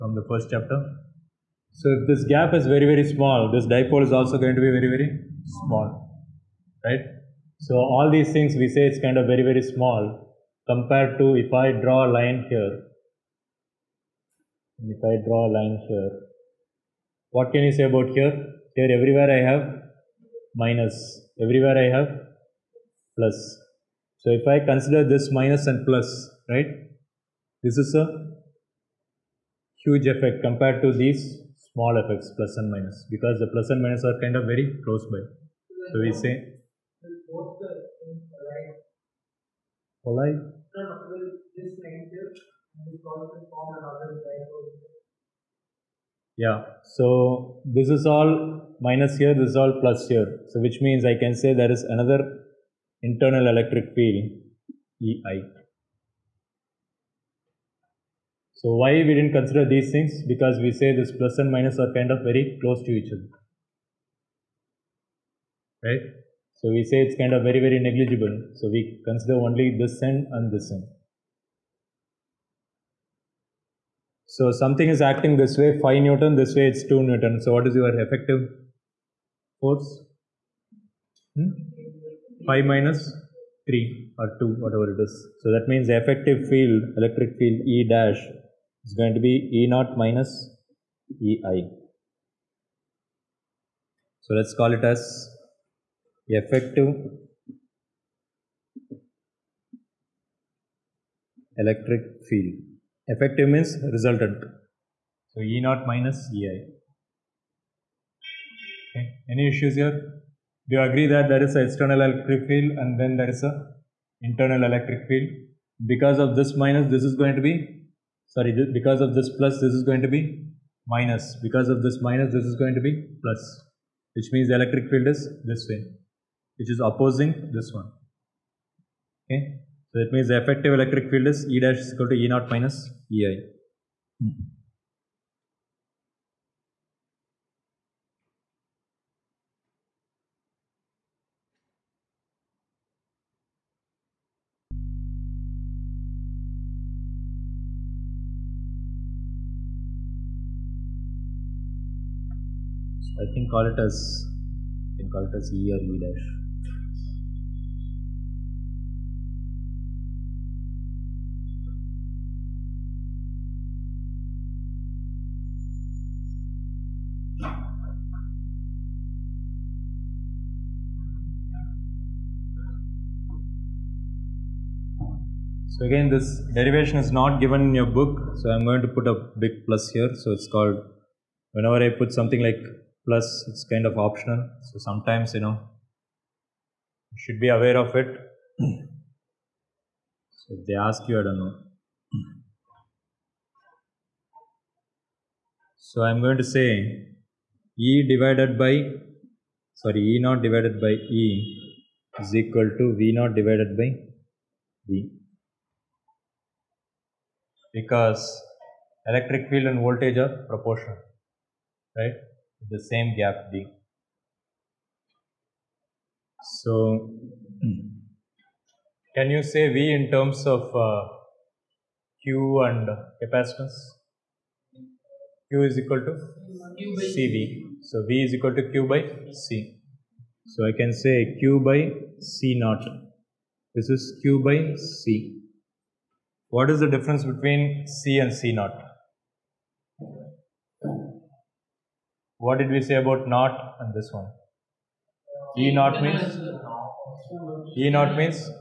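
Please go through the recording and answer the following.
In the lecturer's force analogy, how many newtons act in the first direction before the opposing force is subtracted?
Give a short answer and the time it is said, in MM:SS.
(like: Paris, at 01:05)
5 Newton, at 01:15.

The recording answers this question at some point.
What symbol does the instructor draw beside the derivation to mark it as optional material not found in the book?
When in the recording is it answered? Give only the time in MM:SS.
02:59.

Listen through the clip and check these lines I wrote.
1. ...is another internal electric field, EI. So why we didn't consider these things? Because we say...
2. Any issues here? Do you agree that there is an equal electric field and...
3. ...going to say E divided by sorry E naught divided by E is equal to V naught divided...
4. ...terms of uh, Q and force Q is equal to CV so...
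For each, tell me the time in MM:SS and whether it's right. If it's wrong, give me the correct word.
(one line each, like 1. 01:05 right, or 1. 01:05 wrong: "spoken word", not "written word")
1. 00:51 right
2. 01:49 wrong: "external", not "equal"
3. 03:16 right
4. 03:40 wrong: "capacitance", not "force".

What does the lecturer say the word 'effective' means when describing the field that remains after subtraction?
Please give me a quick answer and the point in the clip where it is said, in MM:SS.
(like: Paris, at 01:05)
Resultant, at 01:43.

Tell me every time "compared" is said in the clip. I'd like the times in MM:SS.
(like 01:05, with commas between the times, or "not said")
00:10, 00:30.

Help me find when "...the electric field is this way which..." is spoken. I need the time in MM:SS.
02:04.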